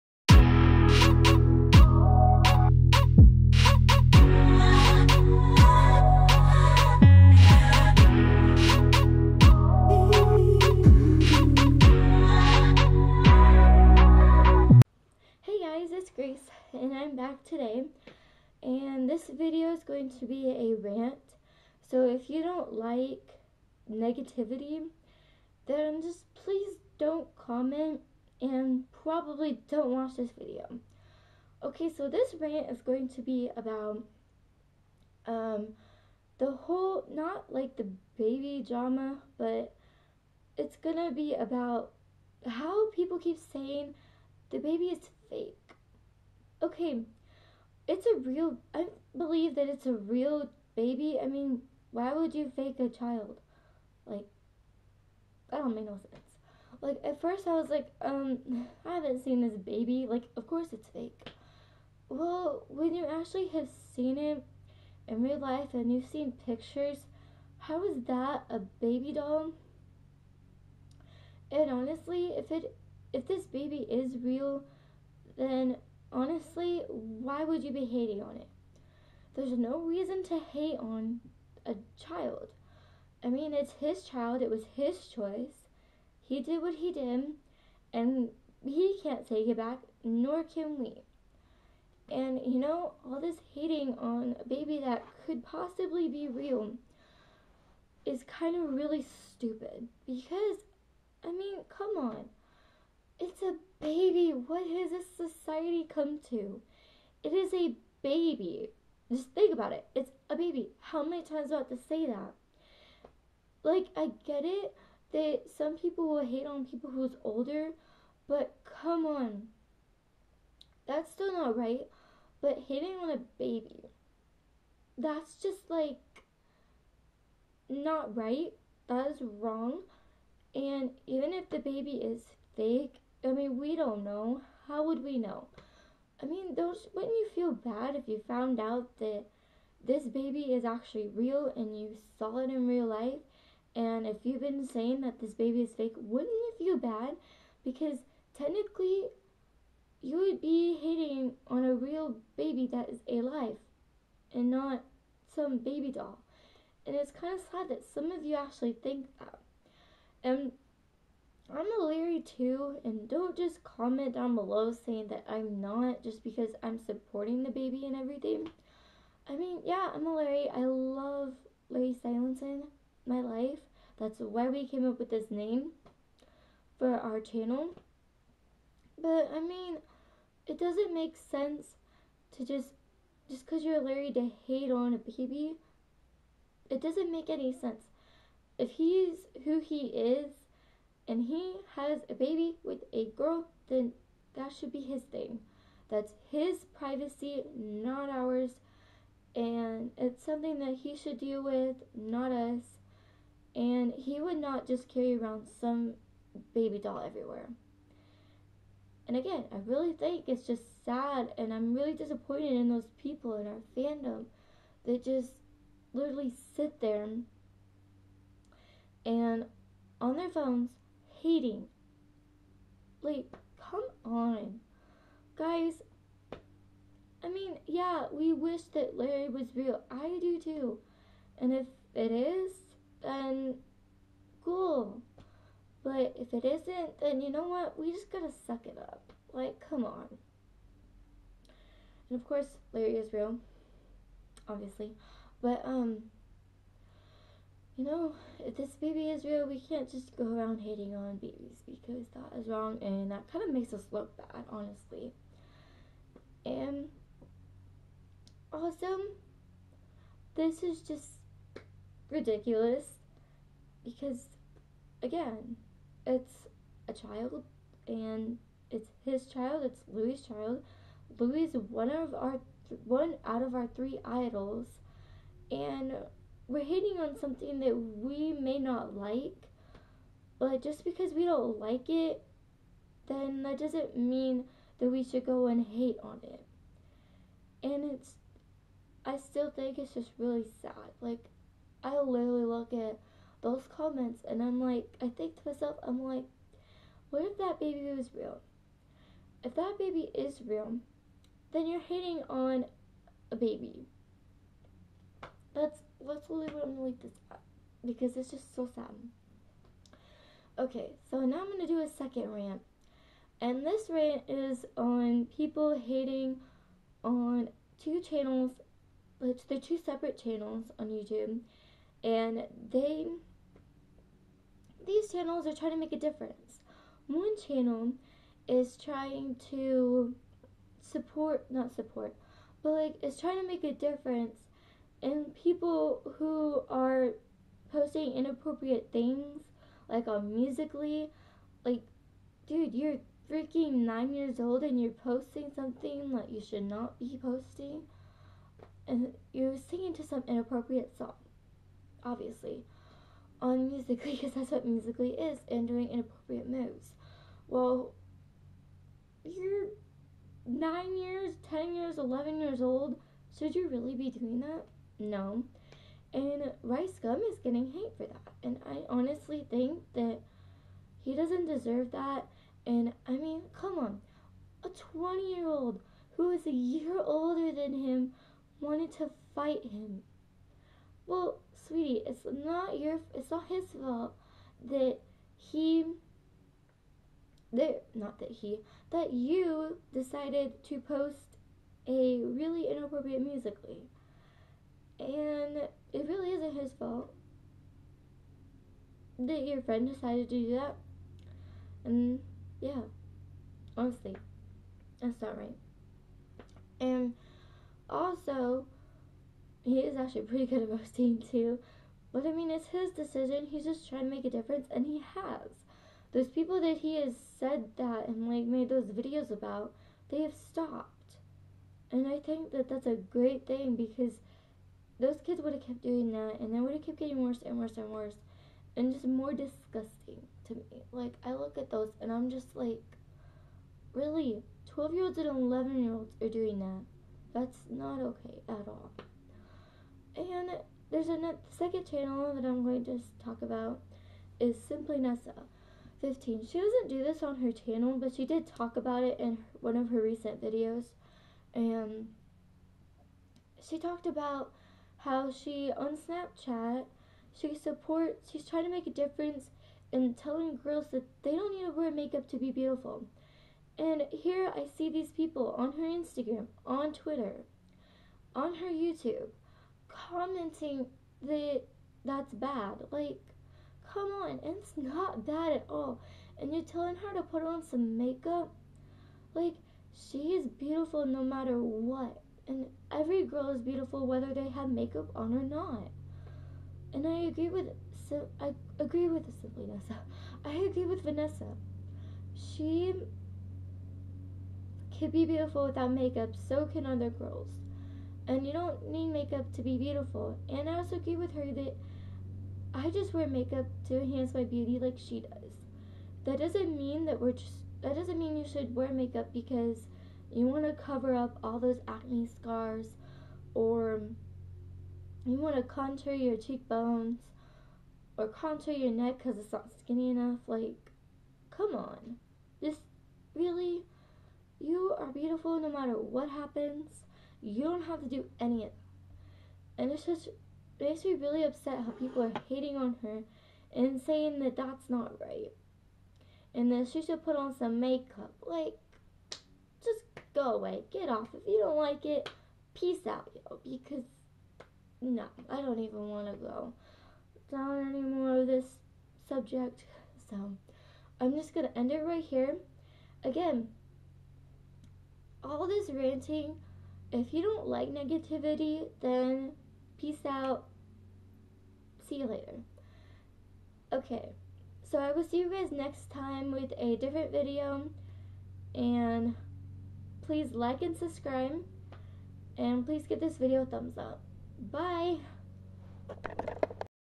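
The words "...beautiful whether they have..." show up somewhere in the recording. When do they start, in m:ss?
8:03.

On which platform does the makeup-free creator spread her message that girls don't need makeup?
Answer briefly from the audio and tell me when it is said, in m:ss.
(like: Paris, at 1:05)
Snapchat, at 7:35.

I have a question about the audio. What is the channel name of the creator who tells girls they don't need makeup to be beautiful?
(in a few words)
Simply Nessa 15.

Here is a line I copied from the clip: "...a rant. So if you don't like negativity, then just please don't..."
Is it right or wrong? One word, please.
right.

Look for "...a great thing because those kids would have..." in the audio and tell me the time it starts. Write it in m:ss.
7:02.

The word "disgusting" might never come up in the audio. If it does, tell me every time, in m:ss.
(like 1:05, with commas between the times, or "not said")
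7:09.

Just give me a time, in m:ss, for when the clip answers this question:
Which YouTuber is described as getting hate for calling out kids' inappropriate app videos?
6:06.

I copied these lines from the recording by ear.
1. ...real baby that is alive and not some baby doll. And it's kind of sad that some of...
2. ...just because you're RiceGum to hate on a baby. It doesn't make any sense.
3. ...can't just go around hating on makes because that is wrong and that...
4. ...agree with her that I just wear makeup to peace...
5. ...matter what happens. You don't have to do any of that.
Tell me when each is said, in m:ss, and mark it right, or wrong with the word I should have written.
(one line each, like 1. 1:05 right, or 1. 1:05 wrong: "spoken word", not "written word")
1. 2:31 right
2. 3:03 wrong: "Larry", not "RiceGum"
3. 4:09 wrong: "babies", not "makes"
4. 8:20 wrong: "enhance", not "peace"
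5. 8:45 right.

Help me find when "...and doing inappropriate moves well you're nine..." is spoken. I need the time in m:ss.
5:55.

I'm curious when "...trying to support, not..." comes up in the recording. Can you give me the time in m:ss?
5:28.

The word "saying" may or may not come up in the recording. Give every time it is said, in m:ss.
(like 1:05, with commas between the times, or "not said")
0:43, 2:24, 2:44, 8:54.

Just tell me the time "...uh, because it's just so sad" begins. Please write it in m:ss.
5:07.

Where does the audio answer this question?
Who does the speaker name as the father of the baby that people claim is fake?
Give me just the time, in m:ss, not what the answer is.
4:29.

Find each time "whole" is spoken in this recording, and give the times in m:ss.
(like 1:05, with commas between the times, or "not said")
0:36.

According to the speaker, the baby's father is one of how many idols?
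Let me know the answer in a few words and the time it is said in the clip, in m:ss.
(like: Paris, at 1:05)
3, at 4:33.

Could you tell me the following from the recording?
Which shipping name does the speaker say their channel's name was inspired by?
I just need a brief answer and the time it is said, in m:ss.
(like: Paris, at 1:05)
Larry Stylinson, at 2:51.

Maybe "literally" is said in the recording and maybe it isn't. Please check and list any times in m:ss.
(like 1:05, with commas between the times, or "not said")
3:35, 4:52.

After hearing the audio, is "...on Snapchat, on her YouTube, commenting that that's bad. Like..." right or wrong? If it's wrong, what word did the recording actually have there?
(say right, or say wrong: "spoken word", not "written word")
wrong: "Twitter", not "Snapchat".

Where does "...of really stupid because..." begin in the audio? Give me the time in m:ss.
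1:38.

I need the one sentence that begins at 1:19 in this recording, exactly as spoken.
There's no reason to hate on a child.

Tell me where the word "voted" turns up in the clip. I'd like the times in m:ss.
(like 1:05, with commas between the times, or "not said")
not said.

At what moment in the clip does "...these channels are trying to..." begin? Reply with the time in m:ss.
5:24.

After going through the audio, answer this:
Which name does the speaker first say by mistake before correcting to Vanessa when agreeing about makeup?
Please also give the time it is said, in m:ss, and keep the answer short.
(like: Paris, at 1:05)
Sabrina, at 8:09.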